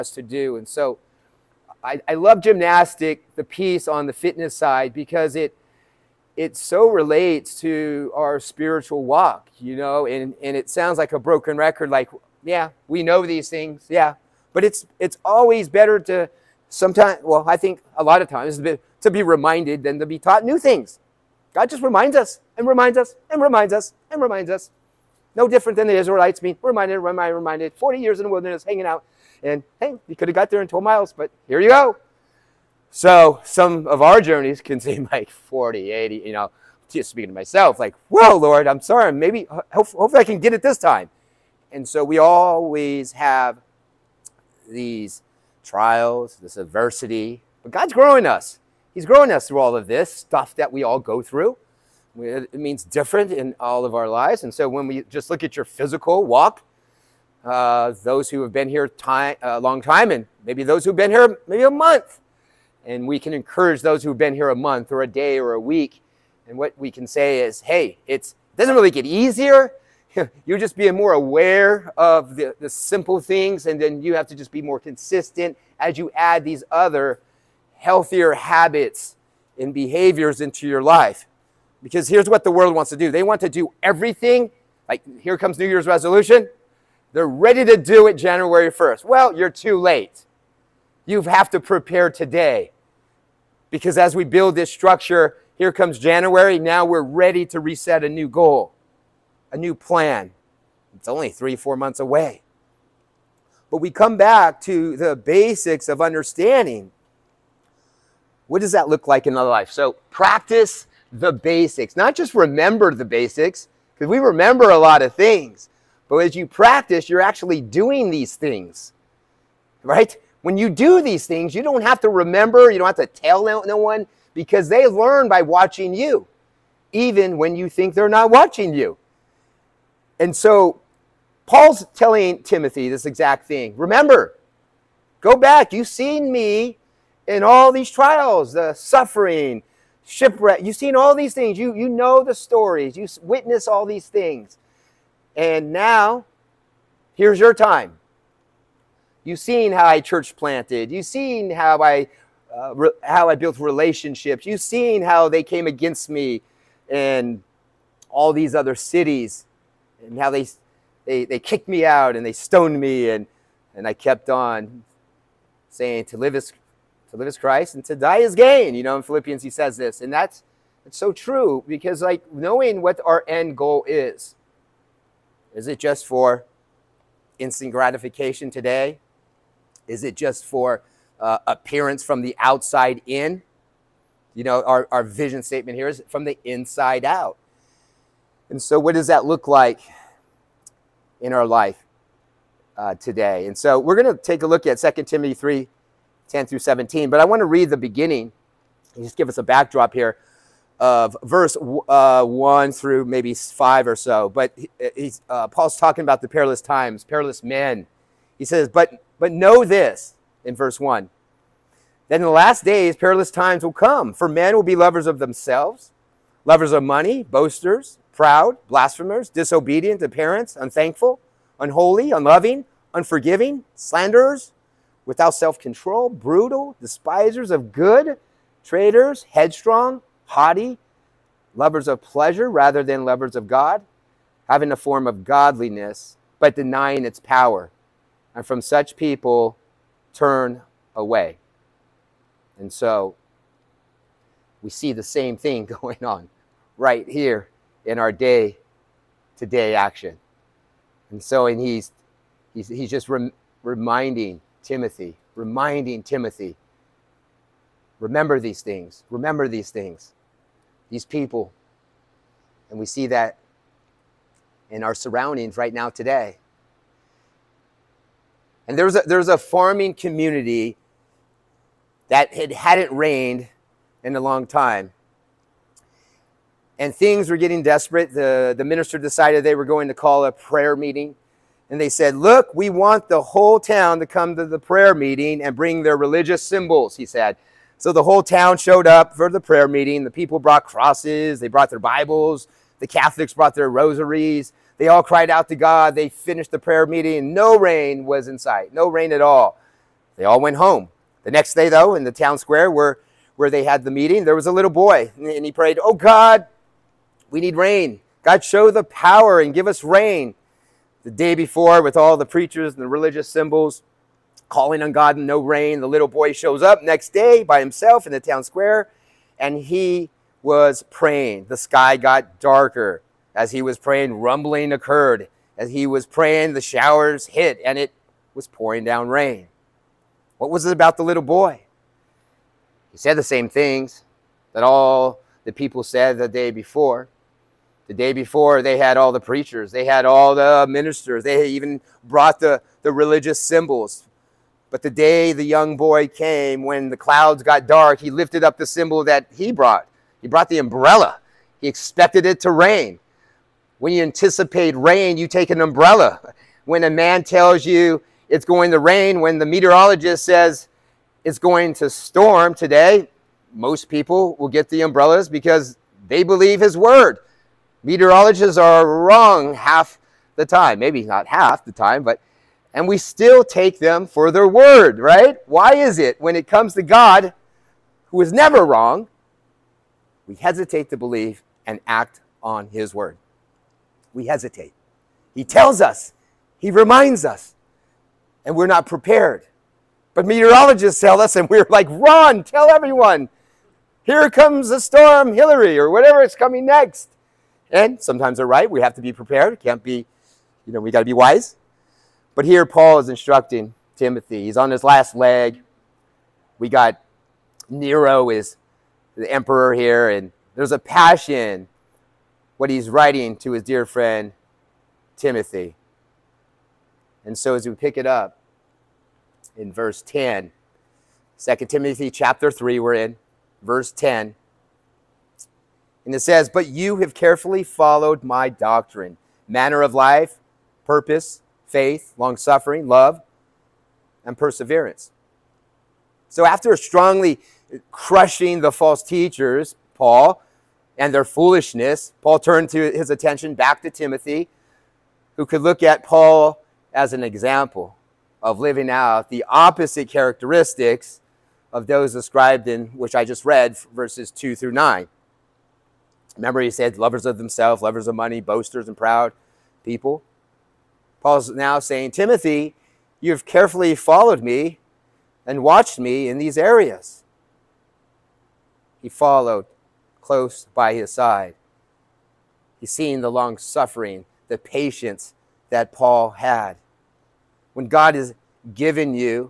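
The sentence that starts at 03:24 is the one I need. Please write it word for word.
But he, uh, Paul's talking about the perilous times, perilous men.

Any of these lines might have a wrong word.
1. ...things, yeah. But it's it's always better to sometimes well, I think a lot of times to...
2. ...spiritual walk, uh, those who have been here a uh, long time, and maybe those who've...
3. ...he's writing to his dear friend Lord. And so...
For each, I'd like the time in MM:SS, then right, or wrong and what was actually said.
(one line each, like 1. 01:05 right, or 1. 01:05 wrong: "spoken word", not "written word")
1. 00:13 right
2. 00:55 wrong: "physical", not "spiritual"
3. 06:52 wrong: "Timothy", not "Lord".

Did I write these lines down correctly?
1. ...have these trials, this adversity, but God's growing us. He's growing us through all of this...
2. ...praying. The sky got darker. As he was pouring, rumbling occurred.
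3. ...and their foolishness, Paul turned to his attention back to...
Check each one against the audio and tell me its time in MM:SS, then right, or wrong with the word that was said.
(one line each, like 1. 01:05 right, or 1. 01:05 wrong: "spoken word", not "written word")
1. 00:43 right
2. 05:20 wrong: "praying", not "pouring"
3. 07:20 right.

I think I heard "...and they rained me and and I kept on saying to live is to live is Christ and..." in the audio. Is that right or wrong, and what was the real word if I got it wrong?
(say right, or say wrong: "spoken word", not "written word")
wrong: "stoned", not "rained".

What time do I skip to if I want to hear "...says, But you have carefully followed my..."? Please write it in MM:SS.
07:06.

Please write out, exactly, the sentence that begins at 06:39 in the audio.
Can't be, you know, we got to be wise.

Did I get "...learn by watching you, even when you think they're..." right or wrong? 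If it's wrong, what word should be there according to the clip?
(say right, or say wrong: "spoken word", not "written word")
right.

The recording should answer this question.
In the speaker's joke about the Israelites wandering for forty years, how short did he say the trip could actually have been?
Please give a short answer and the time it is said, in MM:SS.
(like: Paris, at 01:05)
12 miles, at 00:30.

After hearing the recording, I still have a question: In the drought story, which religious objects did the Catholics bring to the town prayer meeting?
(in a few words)
rosaries.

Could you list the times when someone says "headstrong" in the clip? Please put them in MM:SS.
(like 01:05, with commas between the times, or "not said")
03:49.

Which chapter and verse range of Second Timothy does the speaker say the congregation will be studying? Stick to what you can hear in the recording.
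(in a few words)
3:10-17.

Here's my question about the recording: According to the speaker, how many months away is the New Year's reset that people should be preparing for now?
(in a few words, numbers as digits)
three, four months.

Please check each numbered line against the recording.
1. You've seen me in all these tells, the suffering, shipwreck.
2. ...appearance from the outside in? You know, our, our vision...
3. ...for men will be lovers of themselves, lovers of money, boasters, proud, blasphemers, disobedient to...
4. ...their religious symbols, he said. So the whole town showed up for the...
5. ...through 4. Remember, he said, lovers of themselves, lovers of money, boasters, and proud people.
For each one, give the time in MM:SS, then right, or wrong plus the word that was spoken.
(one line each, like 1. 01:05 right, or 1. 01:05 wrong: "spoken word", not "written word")
1. 02:15 wrong: "trials", not "tells"
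2. 03:01 right
3. 03:34 right
4. 04:45 right
5. 07:34 wrong: "9", not "4".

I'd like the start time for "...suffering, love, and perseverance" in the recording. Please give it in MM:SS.
07:12.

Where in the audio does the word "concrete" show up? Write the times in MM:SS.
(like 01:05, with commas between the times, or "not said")
not said.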